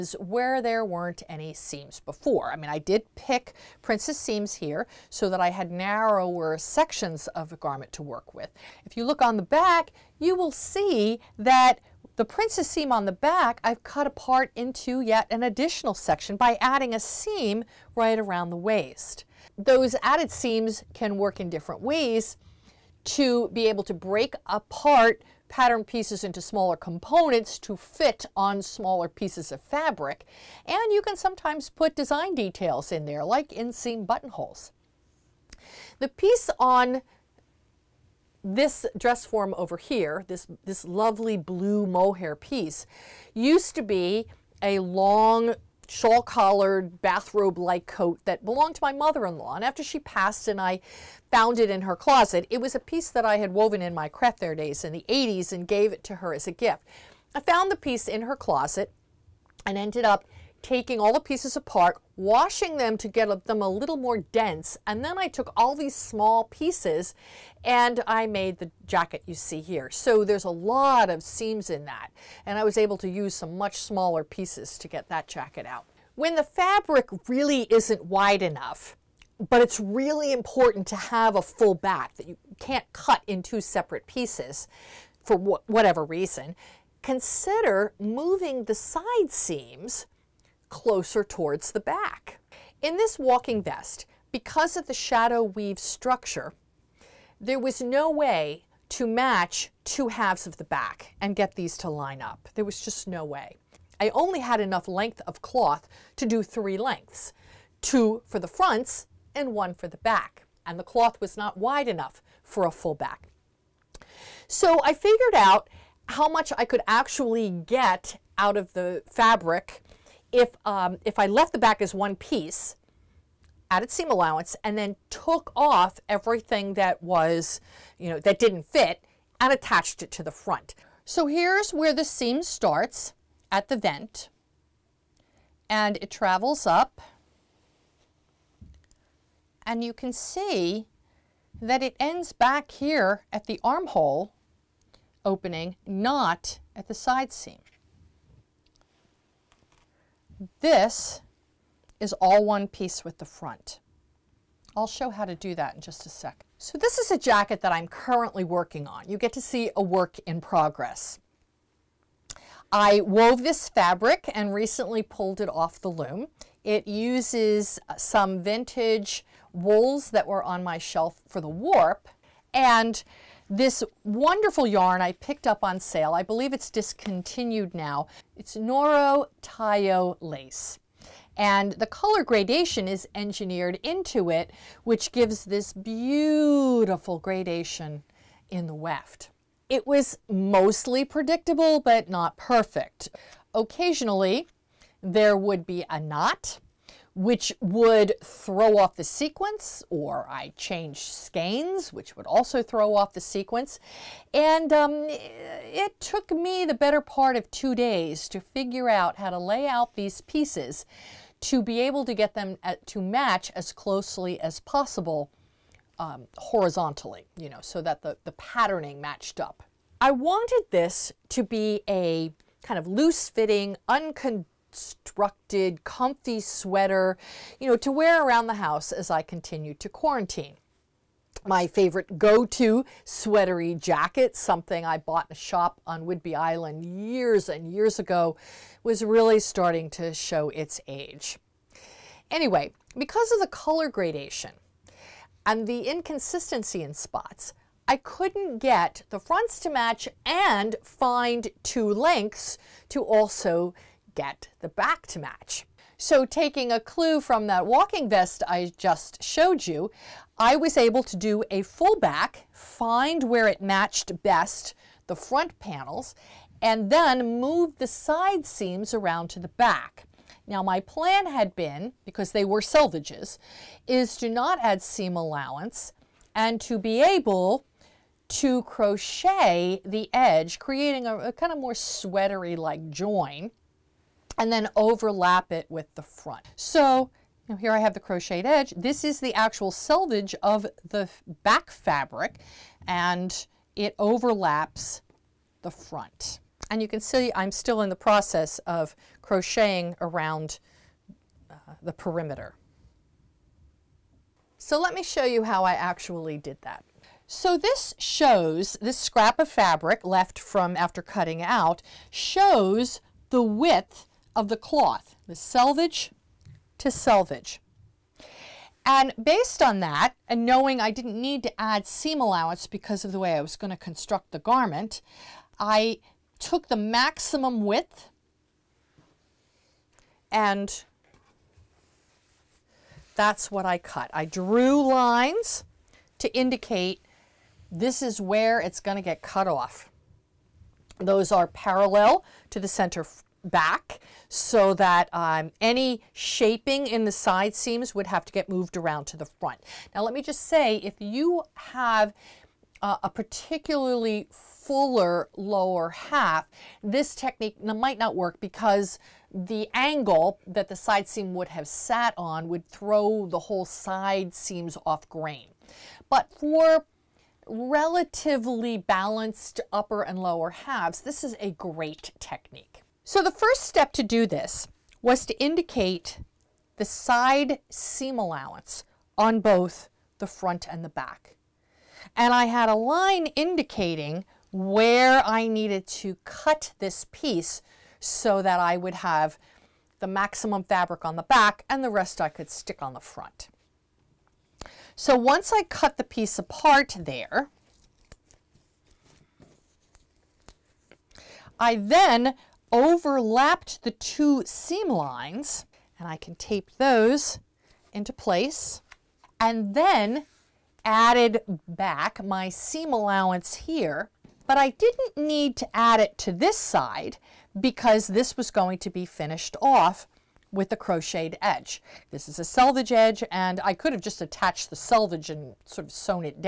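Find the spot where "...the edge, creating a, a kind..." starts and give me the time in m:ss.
4:39.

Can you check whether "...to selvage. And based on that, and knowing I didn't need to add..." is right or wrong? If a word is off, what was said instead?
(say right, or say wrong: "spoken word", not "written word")
right.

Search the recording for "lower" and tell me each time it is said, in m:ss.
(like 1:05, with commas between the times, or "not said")
5:55, 6:10.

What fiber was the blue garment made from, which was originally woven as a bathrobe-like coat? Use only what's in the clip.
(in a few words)
Mohair.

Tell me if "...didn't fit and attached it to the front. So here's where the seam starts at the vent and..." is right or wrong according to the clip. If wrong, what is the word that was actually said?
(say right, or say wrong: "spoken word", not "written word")
right.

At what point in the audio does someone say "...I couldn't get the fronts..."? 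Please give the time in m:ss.
4:07.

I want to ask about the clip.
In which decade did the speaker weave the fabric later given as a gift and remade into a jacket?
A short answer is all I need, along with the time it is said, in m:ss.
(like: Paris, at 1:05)
The 80s, at 0:55.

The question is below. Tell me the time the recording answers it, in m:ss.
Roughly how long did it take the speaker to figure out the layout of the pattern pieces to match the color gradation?
3:27.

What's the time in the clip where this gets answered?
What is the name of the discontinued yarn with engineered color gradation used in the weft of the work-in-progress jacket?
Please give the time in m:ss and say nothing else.
2:58.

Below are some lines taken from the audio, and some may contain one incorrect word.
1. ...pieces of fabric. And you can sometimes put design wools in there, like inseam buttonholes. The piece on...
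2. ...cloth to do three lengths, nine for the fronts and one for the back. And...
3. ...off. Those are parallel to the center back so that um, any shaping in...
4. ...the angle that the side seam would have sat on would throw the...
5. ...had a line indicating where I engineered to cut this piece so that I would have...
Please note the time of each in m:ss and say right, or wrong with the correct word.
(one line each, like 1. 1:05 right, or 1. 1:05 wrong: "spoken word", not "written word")
1. 0:29 wrong: "details", not "wools"
2. 1:45 wrong: "two", not "nine"
3. 5:39 right
4. 5:59 right
5. 6:22 wrong: "needed", not "engineered".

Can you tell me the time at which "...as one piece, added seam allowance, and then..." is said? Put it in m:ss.
2:01.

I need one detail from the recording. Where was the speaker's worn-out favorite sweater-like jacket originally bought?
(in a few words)
Whidbey Island.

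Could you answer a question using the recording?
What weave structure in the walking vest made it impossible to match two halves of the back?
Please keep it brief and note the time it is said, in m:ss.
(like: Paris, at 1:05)
Shadow weave, at 1:34.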